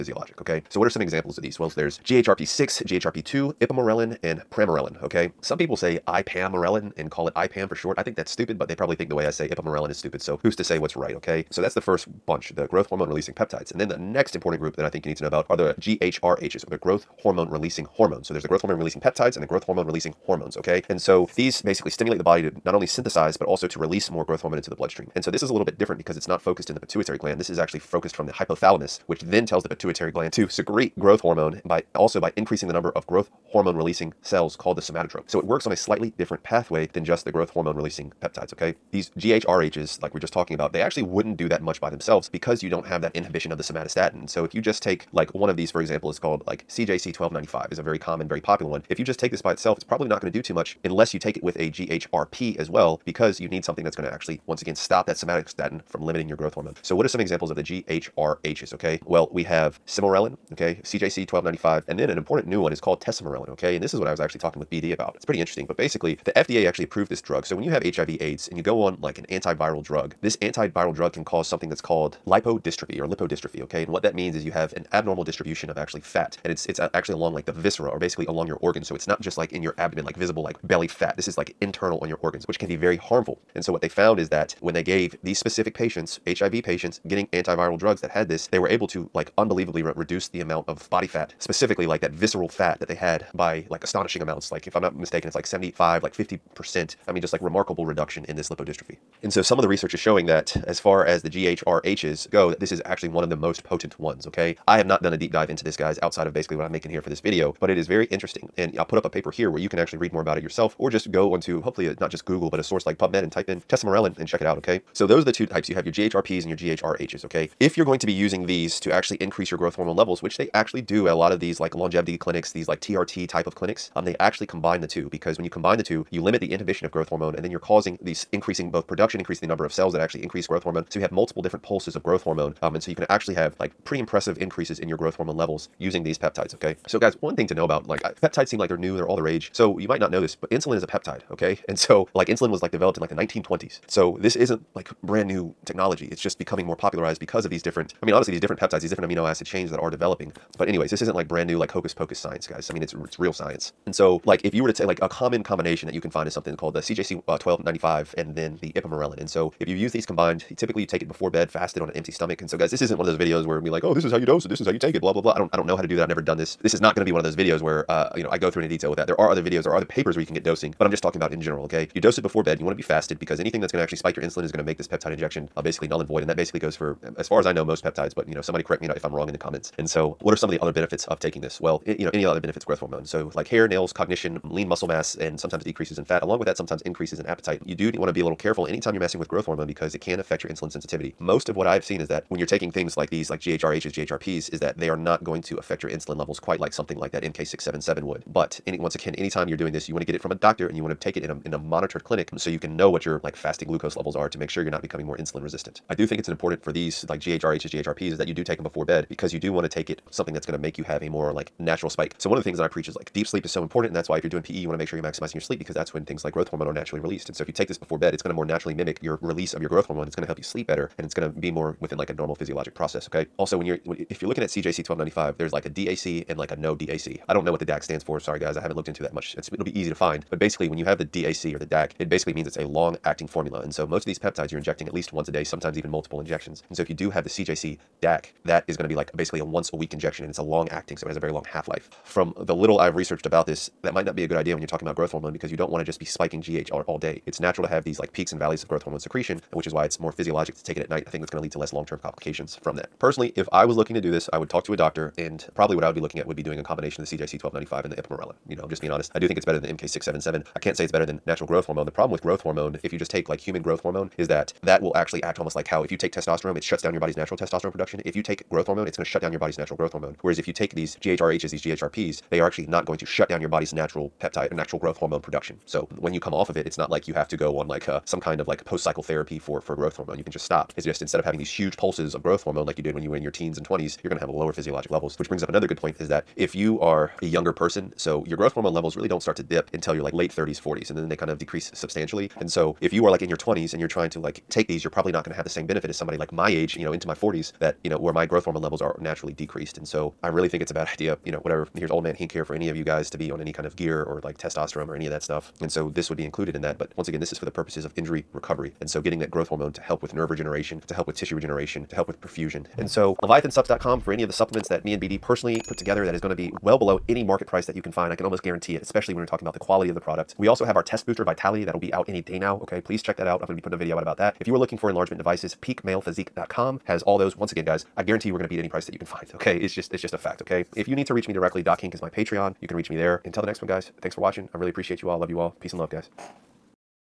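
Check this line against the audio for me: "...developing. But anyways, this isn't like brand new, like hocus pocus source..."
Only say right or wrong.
wrong.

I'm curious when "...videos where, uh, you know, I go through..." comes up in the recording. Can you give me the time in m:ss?
2:47.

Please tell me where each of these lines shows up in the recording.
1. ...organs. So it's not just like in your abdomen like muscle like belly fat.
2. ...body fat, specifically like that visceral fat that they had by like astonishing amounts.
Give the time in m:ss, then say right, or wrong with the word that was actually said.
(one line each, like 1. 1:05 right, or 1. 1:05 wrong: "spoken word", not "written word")
1. 1:18 wrong: "visible", not "muscle"
2. 1:30 right.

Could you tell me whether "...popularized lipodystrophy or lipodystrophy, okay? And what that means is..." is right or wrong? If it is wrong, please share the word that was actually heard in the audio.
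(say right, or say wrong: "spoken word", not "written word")
wrong: "called", not "popularized".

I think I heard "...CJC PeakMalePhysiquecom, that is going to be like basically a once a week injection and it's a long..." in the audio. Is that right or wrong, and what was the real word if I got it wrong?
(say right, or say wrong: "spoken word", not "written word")
wrong: "DAC", not "PeakMalePhysiquecom".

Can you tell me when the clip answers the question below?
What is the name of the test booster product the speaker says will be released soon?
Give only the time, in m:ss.
5:21.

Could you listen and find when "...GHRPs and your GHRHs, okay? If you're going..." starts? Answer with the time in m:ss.
1:55.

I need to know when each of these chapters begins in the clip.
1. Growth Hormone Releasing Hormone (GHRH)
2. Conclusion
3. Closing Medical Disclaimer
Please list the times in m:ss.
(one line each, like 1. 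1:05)
1. 0:11
2. 1:54
3. 5:12.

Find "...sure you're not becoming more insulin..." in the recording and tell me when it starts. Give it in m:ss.
3:24.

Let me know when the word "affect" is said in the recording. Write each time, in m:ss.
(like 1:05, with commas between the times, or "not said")
3:10, 3:15.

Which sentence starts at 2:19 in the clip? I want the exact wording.
So you might not know this, but insulin is a peptide, okay?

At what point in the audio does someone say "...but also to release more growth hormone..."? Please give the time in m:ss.
0:23.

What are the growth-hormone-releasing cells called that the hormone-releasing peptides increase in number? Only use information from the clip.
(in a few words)
somatotrope.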